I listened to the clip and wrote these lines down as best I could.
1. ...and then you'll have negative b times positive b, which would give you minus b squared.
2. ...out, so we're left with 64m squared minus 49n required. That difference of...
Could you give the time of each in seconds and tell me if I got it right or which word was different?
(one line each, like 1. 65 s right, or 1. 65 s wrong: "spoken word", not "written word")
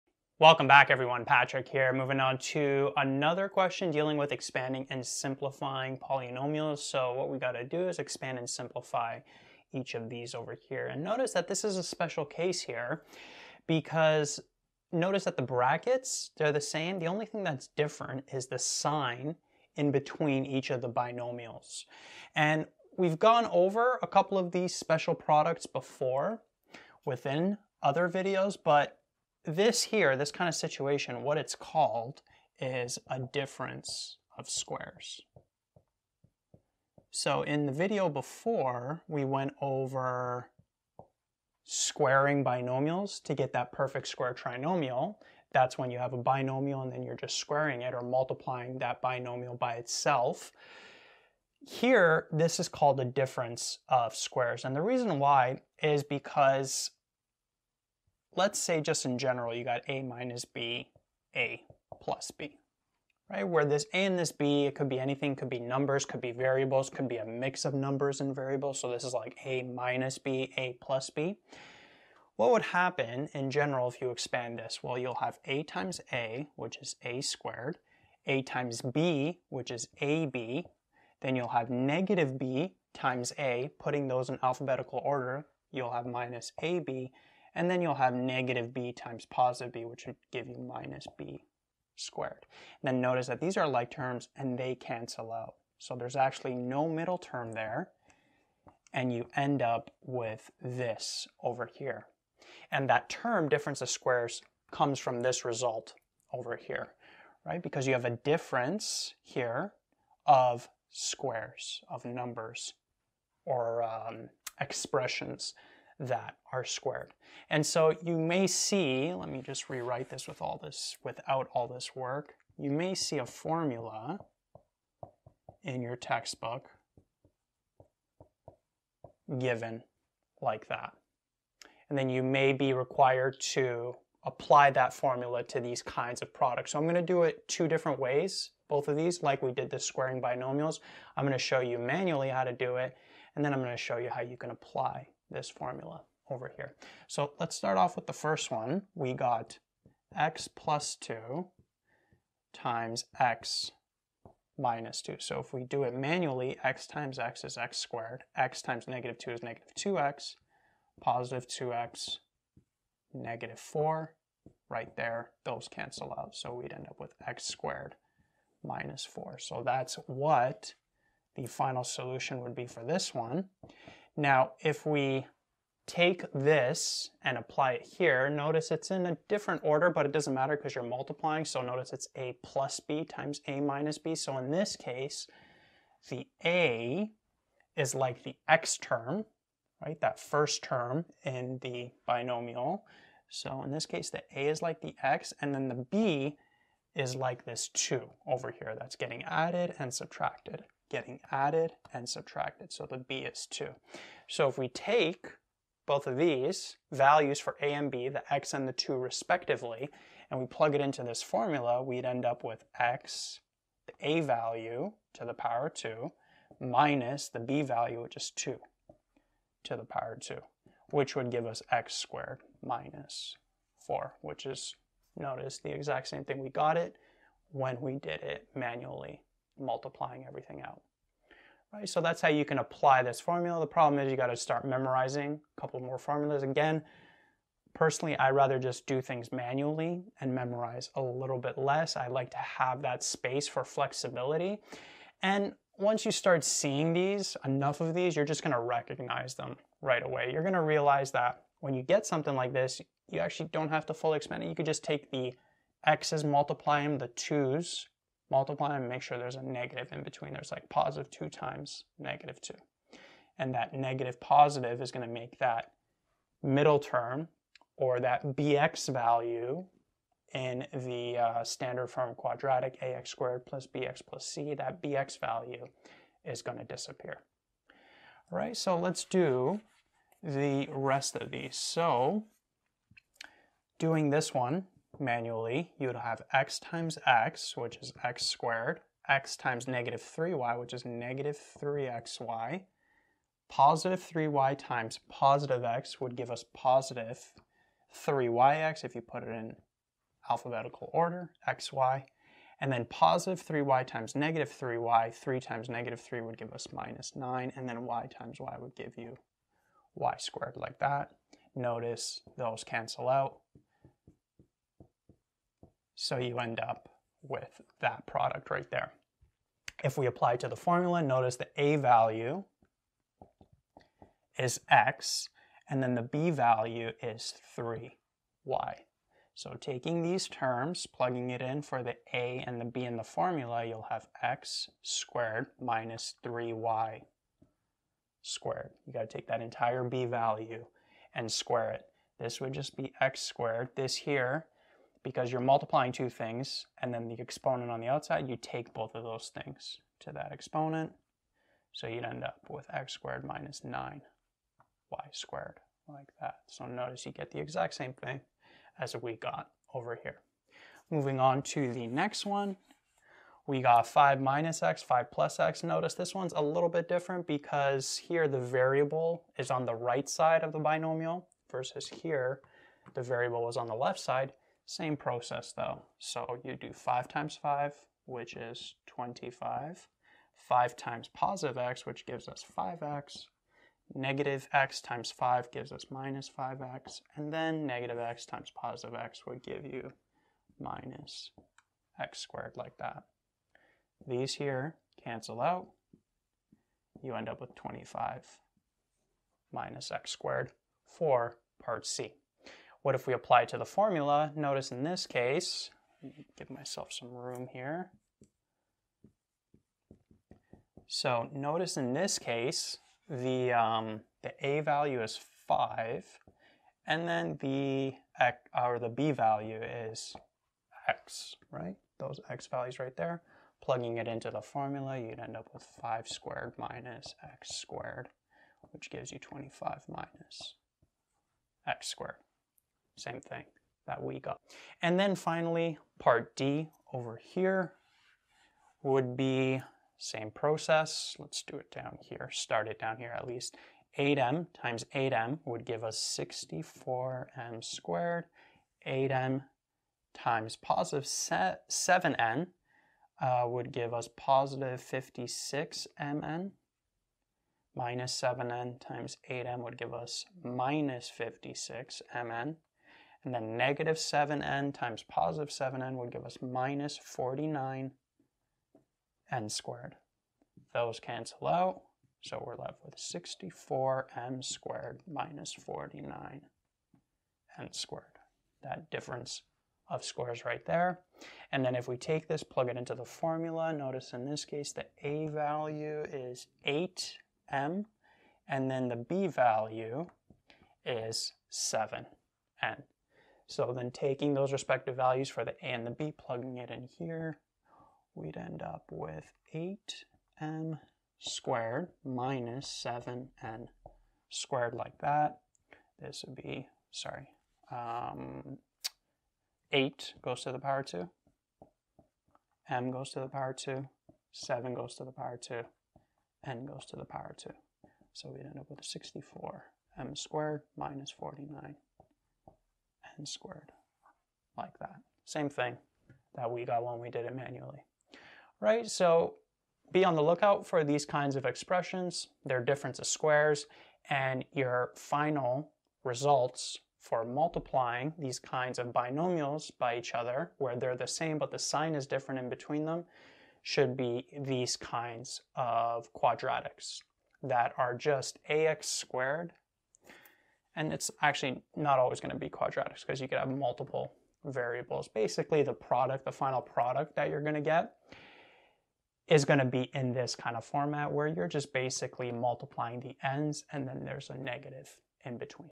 1. 87 s right
2. 471 s wrong: "squared", not "required".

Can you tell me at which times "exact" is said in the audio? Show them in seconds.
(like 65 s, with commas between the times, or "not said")
225 s, 357 s.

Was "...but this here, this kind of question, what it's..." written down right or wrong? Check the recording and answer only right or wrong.
wrong.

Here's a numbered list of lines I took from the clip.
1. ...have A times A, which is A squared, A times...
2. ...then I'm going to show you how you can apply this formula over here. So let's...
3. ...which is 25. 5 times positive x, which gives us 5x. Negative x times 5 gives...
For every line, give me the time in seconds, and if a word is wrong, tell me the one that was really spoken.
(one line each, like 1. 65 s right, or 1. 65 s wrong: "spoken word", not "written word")
1. 75 s right
2. 143 s right
3. 378 s right.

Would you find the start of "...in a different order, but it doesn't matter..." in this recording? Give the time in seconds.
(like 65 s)
178 s.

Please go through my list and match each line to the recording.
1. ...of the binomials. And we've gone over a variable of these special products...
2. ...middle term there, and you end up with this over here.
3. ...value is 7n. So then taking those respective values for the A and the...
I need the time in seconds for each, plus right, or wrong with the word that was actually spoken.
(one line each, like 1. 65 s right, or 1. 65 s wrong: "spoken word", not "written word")
1. 20 s wrong: "couple", not "variable"
2. 96 s right
3. 489 s right.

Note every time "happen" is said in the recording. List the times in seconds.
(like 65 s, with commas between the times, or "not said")
72 s.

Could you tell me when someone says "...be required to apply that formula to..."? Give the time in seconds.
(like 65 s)
132 s.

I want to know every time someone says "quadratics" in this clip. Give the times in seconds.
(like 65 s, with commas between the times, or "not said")
272 s, 546 s, 552 s.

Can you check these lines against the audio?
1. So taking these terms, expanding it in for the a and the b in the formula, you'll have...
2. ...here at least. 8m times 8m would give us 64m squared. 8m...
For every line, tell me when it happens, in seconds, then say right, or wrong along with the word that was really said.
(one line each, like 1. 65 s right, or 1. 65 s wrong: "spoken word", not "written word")
1. 329 s wrong: "plugging", not "expanding"
2. 442 s right.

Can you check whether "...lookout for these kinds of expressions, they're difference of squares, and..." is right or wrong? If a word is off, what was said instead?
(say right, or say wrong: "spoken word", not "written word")
right.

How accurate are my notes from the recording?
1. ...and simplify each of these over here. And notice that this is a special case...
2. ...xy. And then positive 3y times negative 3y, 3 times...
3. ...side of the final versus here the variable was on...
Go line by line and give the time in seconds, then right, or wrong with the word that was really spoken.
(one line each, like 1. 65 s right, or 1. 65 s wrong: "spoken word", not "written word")
1. 8 s right
2. 301 s right
3. 370 s wrong: "binomial", not "final".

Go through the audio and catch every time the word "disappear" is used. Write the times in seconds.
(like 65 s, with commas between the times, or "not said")
276 s.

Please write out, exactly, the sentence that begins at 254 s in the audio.
You could just take the x's, multiply them, the 2's, multiply and make sure there's a negative in between.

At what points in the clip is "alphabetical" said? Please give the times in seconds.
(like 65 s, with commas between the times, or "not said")
84 s, 300 s.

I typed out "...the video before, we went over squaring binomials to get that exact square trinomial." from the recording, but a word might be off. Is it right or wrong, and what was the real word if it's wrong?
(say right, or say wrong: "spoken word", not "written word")
wrong: "perfect", not "exact".